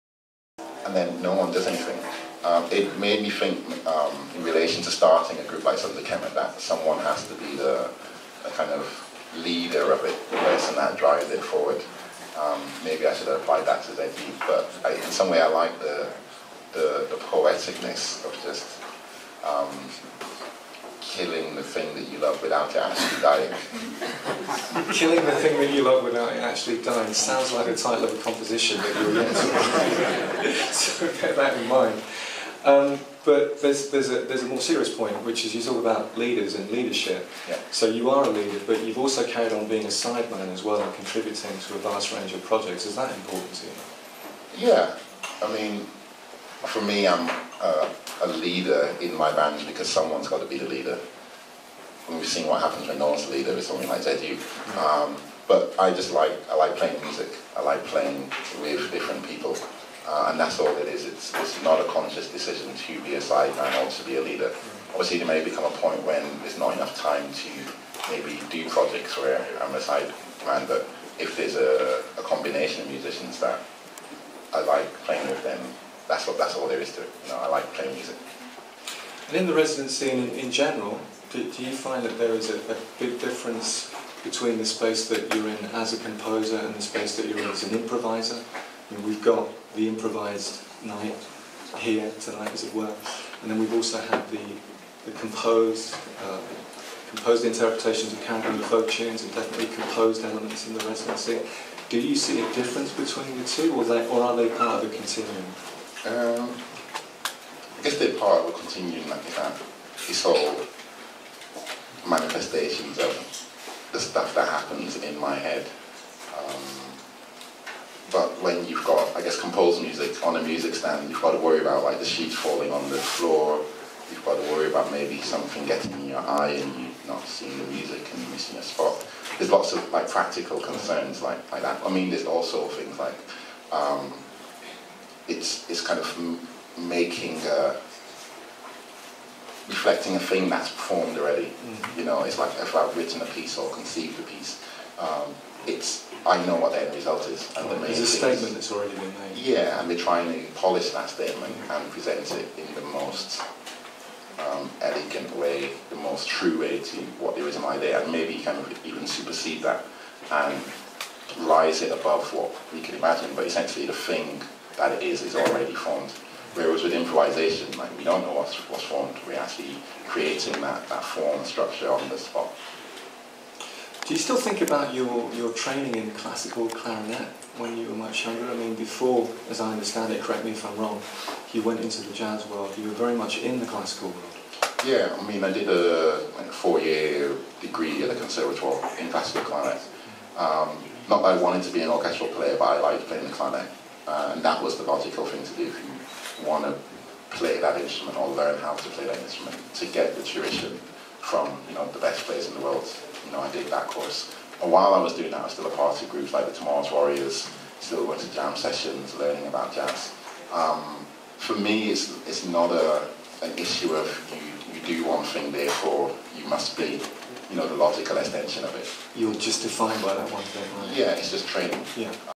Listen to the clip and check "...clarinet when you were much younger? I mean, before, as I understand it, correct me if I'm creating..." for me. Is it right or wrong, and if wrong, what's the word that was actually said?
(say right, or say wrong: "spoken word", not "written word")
wrong: "wrong", not "creating".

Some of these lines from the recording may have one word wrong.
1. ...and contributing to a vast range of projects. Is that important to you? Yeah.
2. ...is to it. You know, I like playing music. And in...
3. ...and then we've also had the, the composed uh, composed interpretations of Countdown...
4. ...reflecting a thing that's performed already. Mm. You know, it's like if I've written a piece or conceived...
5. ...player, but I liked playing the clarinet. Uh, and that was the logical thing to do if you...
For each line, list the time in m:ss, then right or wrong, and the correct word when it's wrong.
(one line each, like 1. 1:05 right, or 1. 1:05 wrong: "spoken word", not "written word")
1. 0:40 right
2. 1:16 right
3. 1:33 right
4. 2:19 right
5. 3:12 right.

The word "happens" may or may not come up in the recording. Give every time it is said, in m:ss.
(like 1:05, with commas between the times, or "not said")
0:52, 1:54.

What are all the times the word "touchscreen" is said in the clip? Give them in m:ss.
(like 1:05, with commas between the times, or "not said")
not said.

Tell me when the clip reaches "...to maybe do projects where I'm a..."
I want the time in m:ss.
1:07.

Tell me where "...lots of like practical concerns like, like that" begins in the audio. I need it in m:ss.
2:09.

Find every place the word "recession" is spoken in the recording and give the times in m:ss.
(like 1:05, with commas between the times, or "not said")
not said.